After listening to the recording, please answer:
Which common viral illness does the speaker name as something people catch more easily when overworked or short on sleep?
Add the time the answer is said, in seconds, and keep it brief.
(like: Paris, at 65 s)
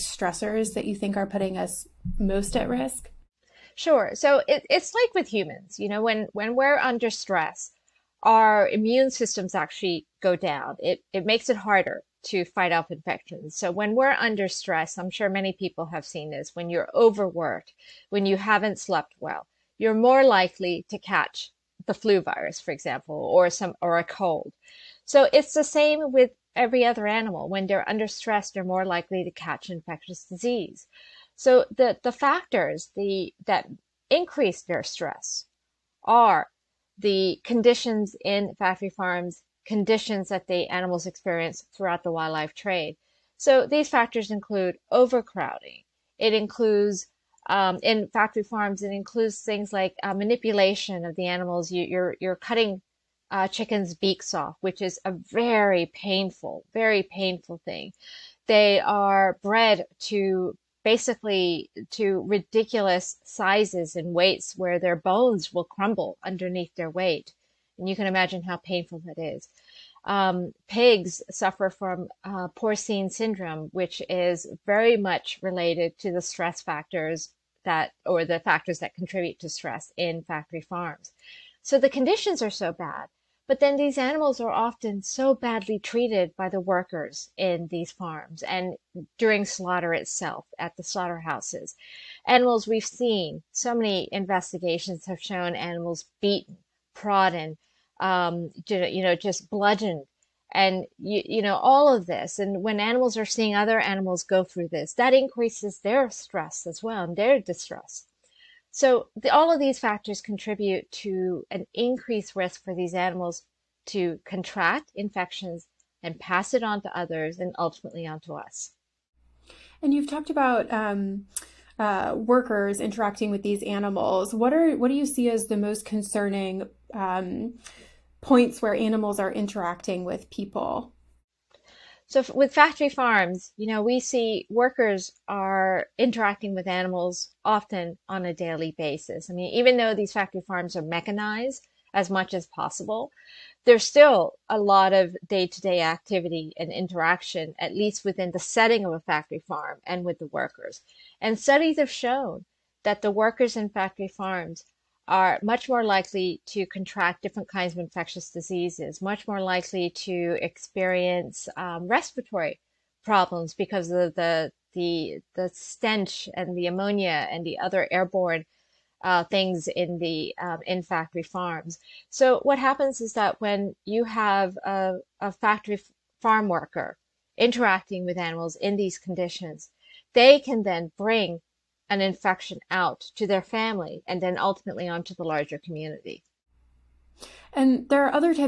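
flu, at 21 s.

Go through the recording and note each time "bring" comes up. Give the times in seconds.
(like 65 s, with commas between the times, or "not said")
180 s.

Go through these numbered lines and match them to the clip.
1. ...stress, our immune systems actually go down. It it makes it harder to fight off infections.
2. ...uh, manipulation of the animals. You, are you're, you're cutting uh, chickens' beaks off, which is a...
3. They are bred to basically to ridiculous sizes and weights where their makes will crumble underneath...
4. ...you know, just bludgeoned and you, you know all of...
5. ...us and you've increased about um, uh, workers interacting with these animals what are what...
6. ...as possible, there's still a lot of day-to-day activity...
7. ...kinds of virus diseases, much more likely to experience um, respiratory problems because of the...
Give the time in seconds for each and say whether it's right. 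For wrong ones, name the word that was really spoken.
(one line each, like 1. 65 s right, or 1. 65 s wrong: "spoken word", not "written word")
1. 7 s right
2. 50 s right
3. 58 s wrong: "bones", not "makes"
4. 98 s right
5. 118 s wrong: "talked", not "increased"
6. 142 s right
7. 157 s wrong: "infectious", not "virus".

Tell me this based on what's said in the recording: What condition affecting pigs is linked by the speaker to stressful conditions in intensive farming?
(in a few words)
porcine syndrome.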